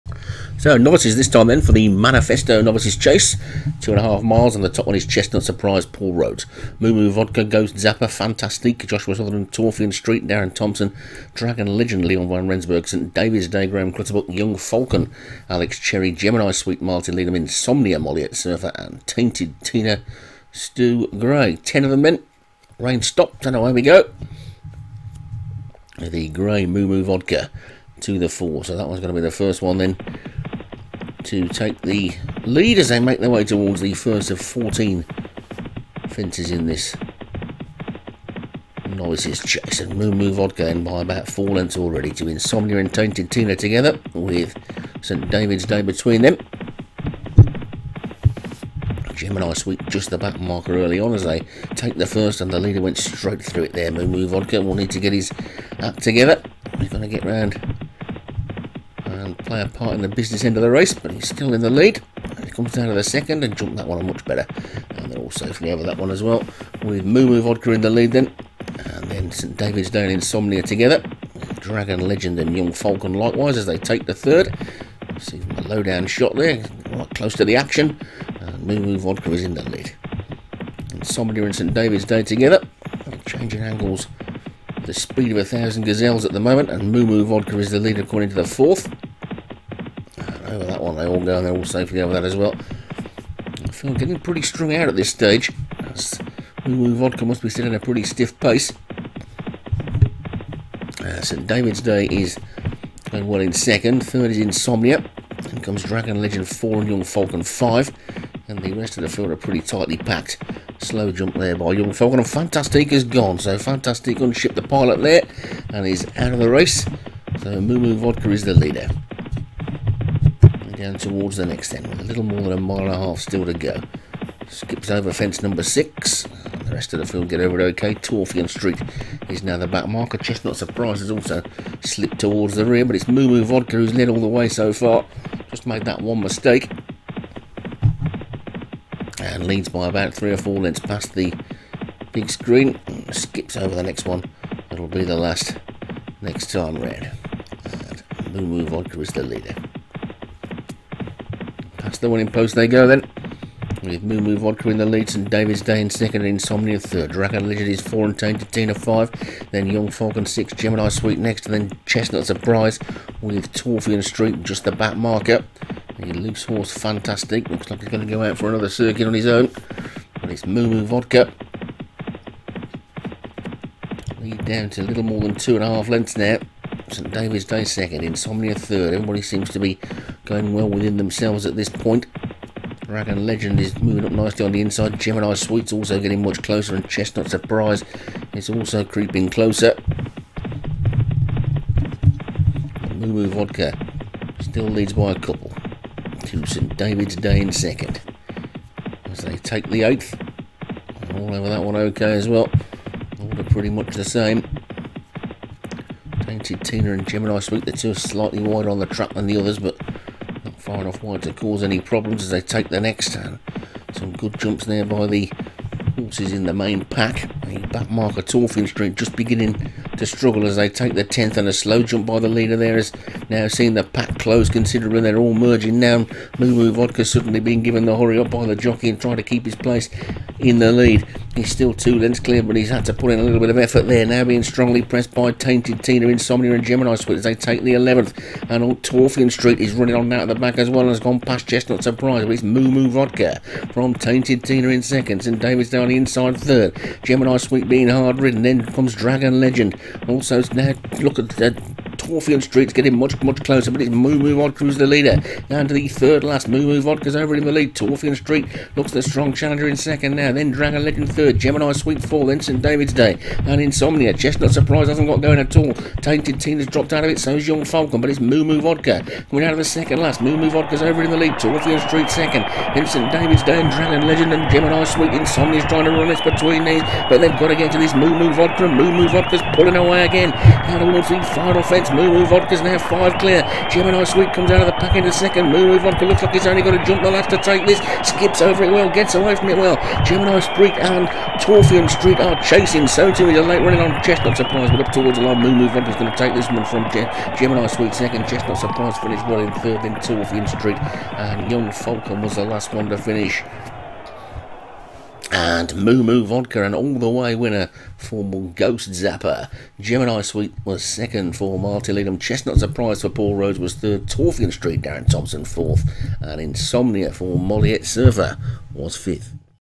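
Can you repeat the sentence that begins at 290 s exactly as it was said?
Gemini Sweet and Torfian Street are chasing.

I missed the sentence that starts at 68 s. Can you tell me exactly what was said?
And then St David's Day and Insomnia together.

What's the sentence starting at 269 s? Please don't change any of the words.
Coming out of the second last, Moo Moo Vodka's over in the lead.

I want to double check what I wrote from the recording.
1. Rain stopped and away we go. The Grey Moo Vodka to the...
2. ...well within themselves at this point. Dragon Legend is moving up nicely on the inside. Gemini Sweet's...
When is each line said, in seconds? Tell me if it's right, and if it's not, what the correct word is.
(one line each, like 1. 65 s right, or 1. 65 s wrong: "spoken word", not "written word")
1. 22 s right
2. 180 s right.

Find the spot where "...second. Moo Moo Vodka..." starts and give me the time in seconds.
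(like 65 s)
285 s.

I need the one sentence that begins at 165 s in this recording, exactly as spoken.
The loose horse Fantastic looks like he's going to go out for another circuit on his own, And it's Moo Moo Vodka.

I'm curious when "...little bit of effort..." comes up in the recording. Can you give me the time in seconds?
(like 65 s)
233 s.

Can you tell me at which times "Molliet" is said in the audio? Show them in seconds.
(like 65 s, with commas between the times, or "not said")
17 s, 317 s.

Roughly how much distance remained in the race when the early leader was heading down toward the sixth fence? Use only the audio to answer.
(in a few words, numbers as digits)
A little more than a mile and a half.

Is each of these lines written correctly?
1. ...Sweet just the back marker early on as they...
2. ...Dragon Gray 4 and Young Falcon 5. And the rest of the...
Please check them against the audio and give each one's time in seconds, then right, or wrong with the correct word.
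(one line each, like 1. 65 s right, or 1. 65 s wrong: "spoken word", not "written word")
1. 49 s right
2. 105 s wrong: "Legend", not "Gray".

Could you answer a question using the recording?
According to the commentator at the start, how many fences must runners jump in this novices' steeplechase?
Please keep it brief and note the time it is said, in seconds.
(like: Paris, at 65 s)
14, at 34 s.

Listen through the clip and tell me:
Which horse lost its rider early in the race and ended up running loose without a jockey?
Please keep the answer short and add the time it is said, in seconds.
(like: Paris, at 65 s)
Fantastique, at 112 s.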